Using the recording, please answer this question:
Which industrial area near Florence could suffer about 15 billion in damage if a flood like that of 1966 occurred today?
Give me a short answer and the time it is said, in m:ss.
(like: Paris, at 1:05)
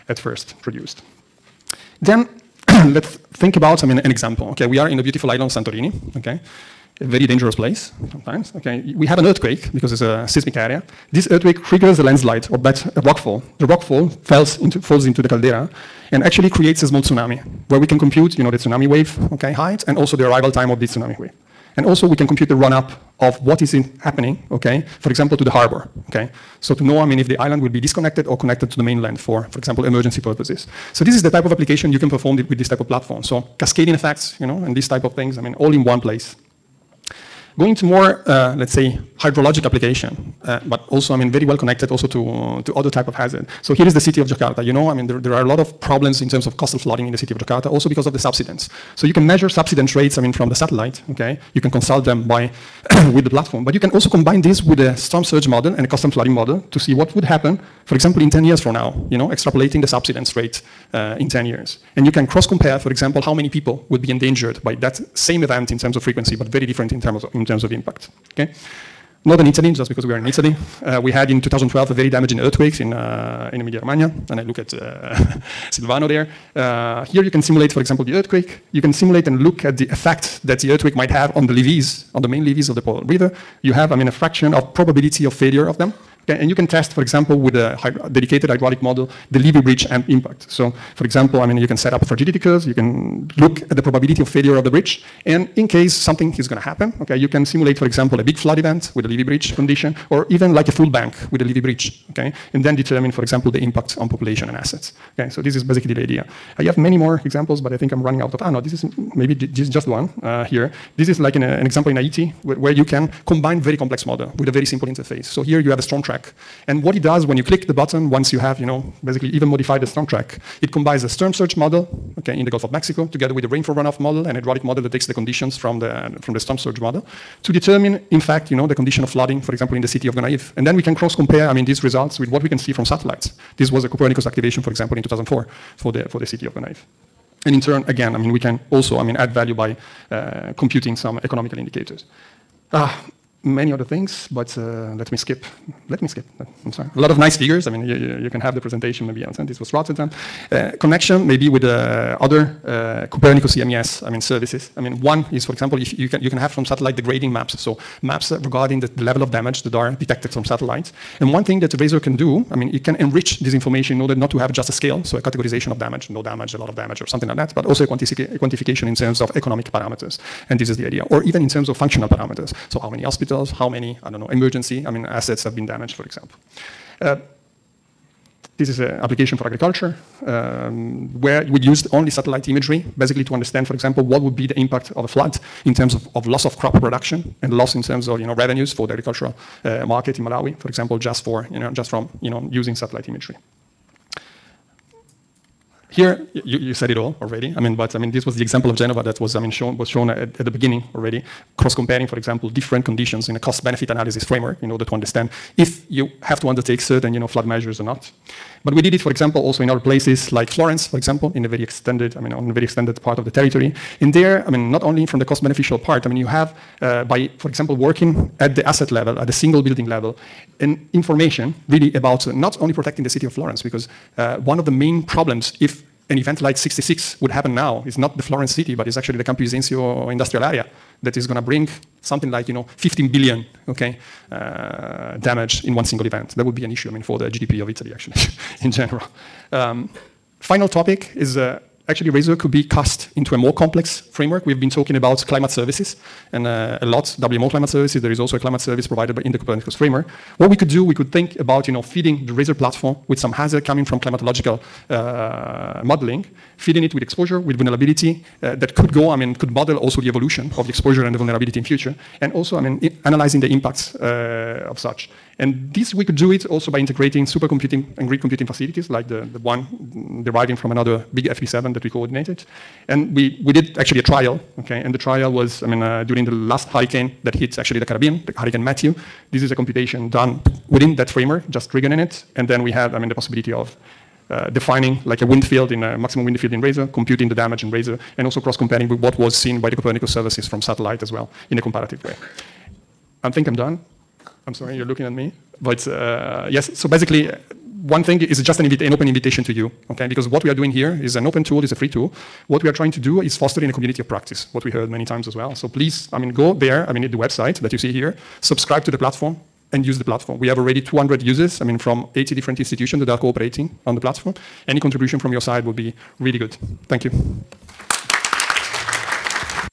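Campi Bisenzio, at 3:49.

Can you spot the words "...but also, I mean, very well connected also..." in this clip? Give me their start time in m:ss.
0:40.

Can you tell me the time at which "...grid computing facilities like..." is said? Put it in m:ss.
4:28.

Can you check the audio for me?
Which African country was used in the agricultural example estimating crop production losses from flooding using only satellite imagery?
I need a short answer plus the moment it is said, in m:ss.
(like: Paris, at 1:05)
Malawi, at 3:10.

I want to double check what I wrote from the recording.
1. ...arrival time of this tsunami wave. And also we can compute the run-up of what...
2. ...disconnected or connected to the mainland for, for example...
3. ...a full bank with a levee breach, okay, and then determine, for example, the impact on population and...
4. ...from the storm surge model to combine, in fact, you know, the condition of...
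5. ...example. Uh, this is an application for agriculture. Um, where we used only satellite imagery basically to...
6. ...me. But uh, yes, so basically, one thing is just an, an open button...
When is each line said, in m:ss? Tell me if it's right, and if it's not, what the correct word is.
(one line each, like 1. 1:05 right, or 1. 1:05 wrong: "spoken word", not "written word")
1. 0:20 right
2. 0:27 right
3. 1:40 right
4. 2:06 wrong: "determine", not "combine"
5. 2:56 right
6. 4:55 wrong: "invitation", not "button".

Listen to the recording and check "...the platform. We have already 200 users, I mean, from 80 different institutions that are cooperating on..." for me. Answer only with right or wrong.
right.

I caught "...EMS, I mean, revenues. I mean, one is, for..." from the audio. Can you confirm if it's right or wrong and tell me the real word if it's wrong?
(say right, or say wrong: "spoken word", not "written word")
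wrong: "services", not "revenues".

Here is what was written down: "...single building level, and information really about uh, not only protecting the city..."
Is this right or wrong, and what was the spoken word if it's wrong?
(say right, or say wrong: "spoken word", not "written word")
right.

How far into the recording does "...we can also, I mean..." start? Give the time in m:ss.
2:18.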